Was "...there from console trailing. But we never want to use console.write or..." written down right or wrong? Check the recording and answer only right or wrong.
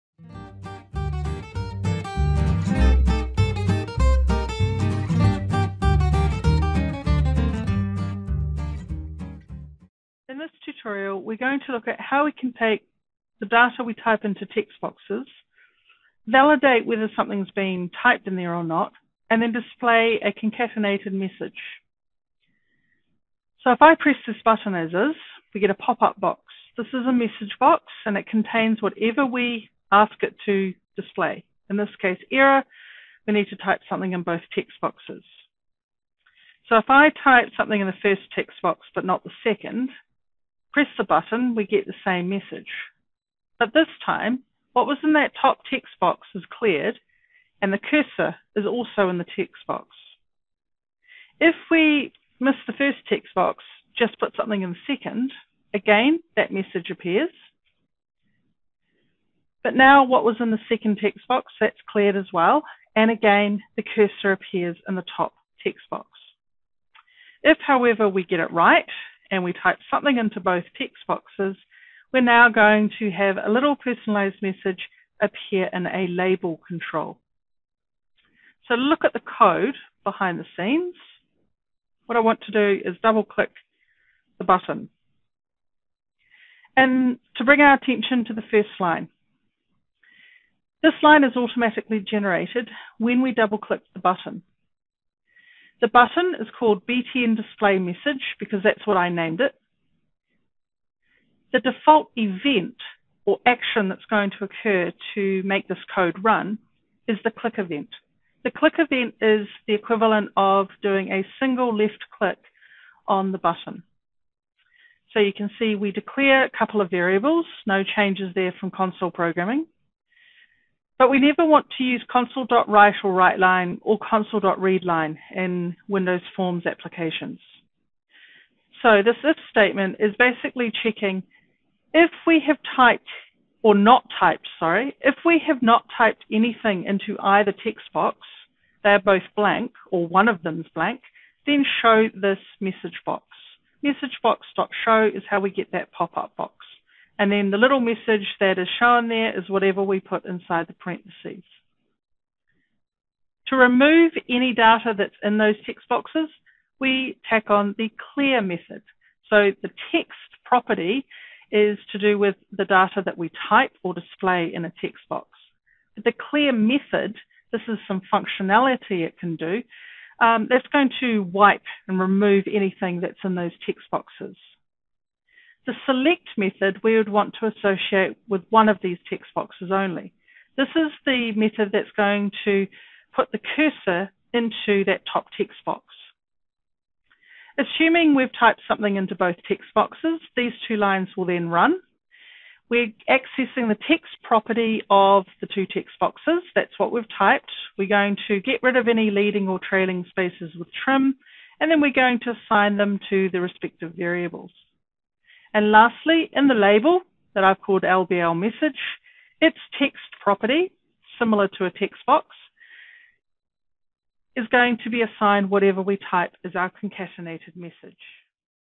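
wrong.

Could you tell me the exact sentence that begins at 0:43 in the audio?
But this time, what was in that top text box is cleared and the cursor is also in the text box.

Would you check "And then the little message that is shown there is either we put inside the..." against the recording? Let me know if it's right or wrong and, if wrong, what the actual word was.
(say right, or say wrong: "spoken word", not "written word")
wrong: "whatever", not "either".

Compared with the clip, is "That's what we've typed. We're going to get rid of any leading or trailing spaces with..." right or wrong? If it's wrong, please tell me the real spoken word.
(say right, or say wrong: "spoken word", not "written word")
right.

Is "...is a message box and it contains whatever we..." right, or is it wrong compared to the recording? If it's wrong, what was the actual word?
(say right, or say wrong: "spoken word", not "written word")
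right.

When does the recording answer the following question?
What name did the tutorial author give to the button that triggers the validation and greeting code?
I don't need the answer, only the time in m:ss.
1:36.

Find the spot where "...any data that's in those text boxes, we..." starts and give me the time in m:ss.
2:34.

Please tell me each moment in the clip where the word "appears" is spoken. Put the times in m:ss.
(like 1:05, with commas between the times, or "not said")
0:56, 1:04, 1:15.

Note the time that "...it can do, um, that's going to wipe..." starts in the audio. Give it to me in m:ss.
2:49.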